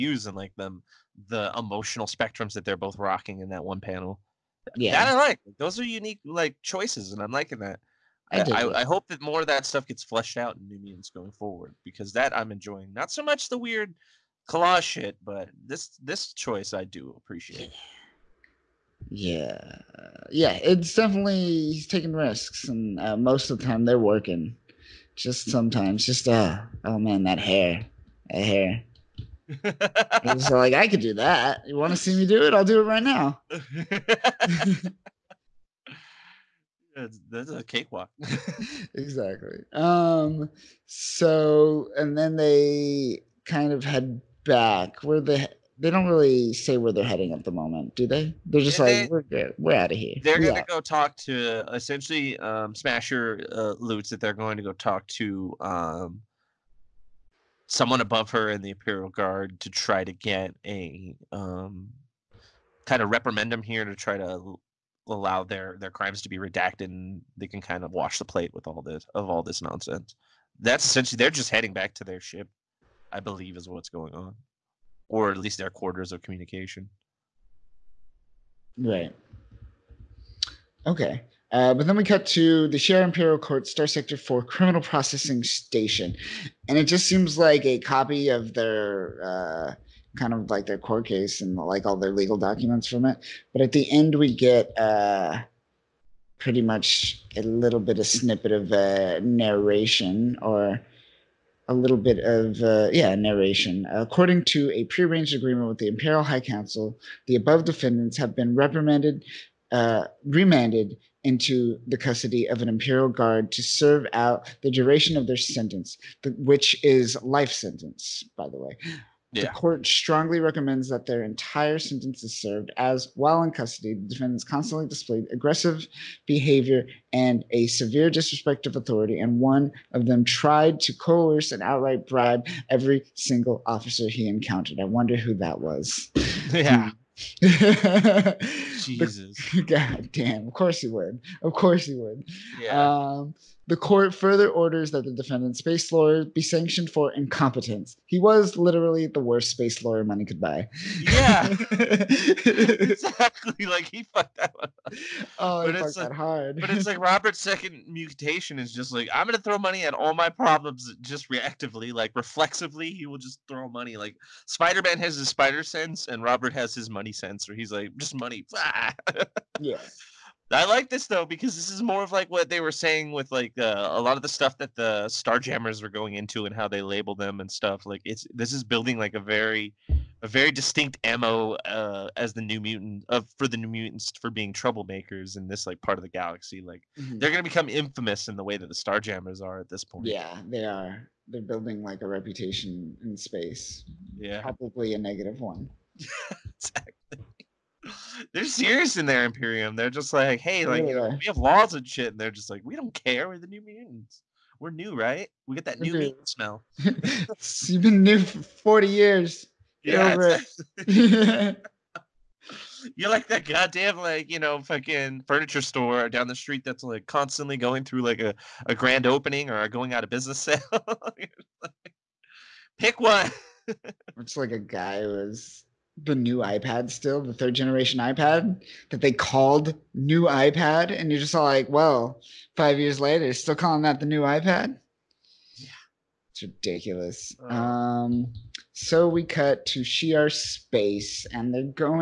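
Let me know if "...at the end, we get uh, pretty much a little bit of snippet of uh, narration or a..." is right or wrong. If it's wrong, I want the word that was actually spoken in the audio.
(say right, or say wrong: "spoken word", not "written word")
right.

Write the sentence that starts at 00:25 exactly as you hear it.
Just sometimes, just uh, oh man, that hair, that hair.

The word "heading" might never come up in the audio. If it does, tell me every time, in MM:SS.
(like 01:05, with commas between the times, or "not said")
00:47, 01:11.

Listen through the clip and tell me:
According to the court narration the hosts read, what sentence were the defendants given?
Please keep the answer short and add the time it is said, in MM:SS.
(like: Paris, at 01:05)
Life sentence, at 01:57.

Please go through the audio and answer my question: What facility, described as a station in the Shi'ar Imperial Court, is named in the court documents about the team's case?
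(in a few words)
Star Sector 4 Criminal Processing Station.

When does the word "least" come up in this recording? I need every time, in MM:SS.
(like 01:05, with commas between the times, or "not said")
01:15.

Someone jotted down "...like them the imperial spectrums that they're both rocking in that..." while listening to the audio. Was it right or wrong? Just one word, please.
wrong.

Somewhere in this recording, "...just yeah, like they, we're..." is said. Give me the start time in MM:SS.
00:48.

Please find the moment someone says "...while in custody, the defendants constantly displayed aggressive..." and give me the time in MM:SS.
02:03.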